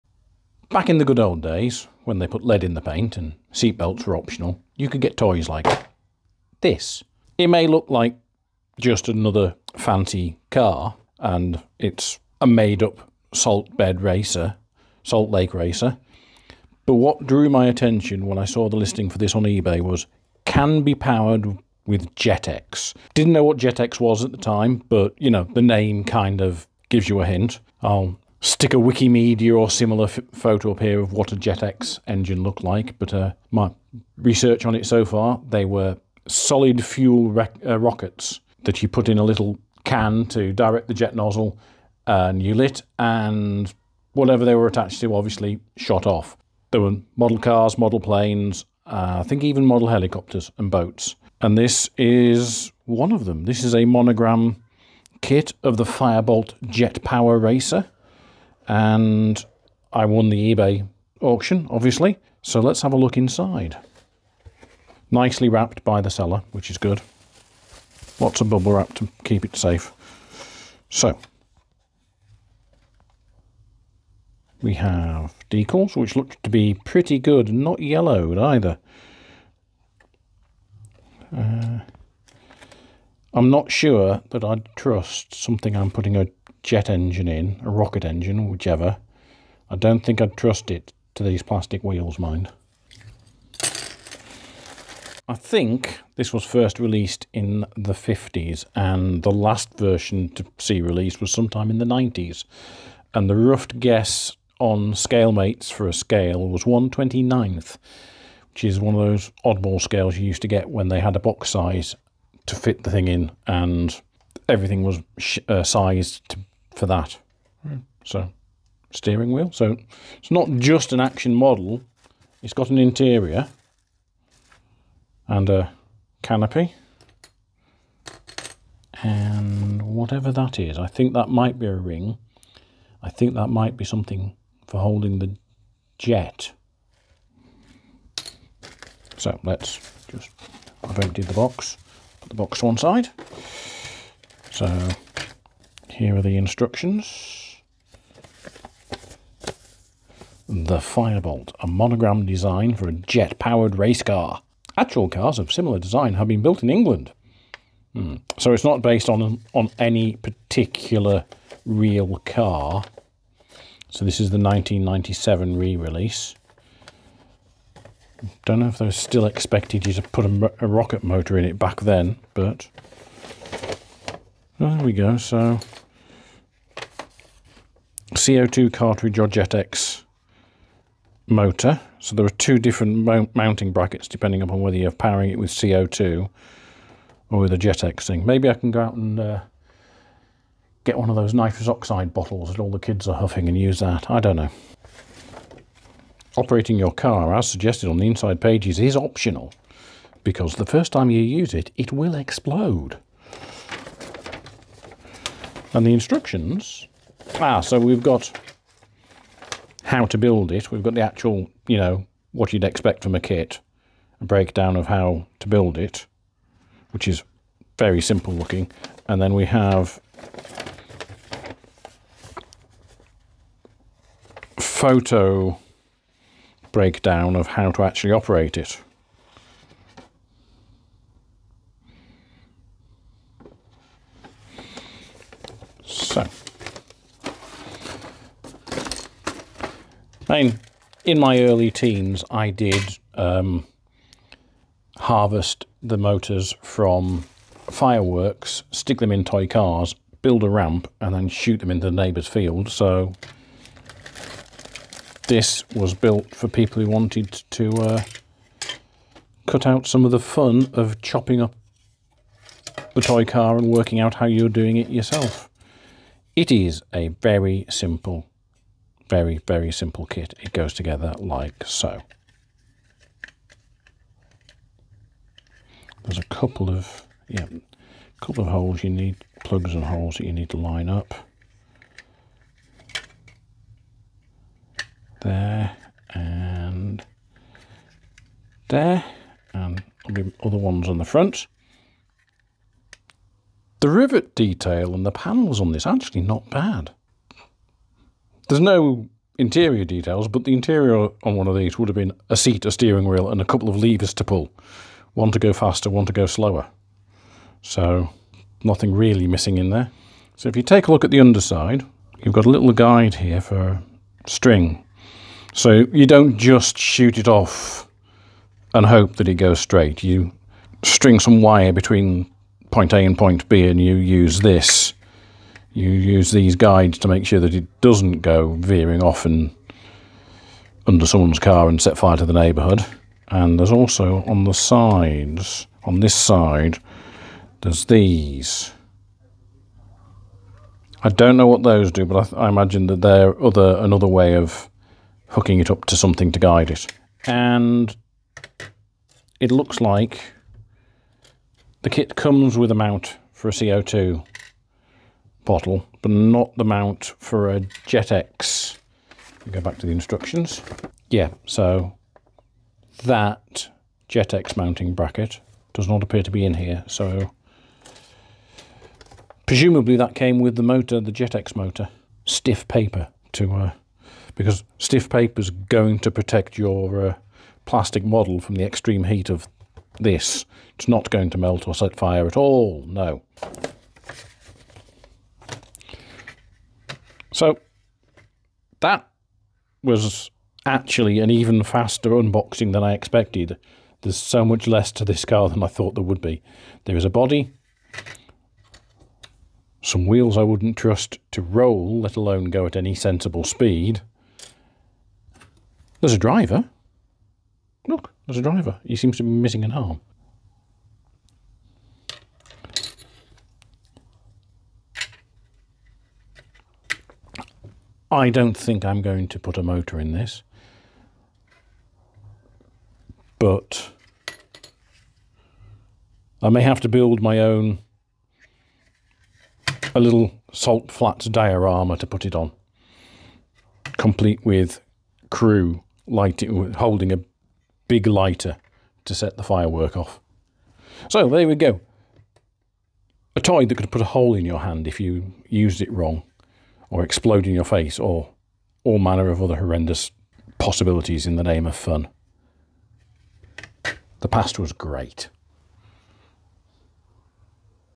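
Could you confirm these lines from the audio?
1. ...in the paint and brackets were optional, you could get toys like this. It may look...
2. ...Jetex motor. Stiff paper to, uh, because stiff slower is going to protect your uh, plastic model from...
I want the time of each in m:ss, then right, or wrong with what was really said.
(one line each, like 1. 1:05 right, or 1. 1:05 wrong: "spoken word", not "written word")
1. 0:02 wrong: "seatbelts", not "brackets"
2. 6:11 wrong: "paper", not "slower".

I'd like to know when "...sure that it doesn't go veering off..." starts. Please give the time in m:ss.
5:27.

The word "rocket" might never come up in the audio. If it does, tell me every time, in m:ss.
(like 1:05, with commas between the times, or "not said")
0:37, 1:27, 2:50.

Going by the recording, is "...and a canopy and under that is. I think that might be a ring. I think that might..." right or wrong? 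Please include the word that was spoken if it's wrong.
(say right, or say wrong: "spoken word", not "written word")
wrong: "whatever", not "under".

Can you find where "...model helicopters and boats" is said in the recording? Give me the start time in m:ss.
0:49.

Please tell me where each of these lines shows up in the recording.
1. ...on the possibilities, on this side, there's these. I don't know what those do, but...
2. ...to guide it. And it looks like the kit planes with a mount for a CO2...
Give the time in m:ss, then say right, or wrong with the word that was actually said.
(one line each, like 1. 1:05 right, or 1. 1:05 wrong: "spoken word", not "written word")
1. 5:34 wrong: "sides", not "possibilities"
2. 5:46 wrong: "comes", not "planes".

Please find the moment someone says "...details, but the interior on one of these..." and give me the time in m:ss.
4:59.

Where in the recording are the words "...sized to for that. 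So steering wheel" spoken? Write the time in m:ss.
1:55.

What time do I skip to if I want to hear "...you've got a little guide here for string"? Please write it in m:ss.
5:12.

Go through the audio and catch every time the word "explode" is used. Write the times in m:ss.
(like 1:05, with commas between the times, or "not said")
3:22, 7:27.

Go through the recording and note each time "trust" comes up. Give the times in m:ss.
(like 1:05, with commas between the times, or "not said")
1:24, 1:30, 6:40.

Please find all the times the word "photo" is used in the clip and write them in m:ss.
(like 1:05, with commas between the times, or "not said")
0:30, 3:44.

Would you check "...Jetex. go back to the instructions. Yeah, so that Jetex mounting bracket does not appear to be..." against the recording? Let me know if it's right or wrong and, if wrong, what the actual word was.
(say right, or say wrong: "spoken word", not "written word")
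right.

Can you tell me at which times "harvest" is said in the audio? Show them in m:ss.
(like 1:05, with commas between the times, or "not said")
4:04.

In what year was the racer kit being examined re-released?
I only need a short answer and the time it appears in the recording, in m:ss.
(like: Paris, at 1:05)
1997, at 2:44.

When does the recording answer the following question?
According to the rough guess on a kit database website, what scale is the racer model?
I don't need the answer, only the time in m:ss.
1:46.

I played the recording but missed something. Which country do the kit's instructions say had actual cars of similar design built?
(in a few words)
England.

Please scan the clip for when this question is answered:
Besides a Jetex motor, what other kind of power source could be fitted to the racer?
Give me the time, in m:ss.
2:58.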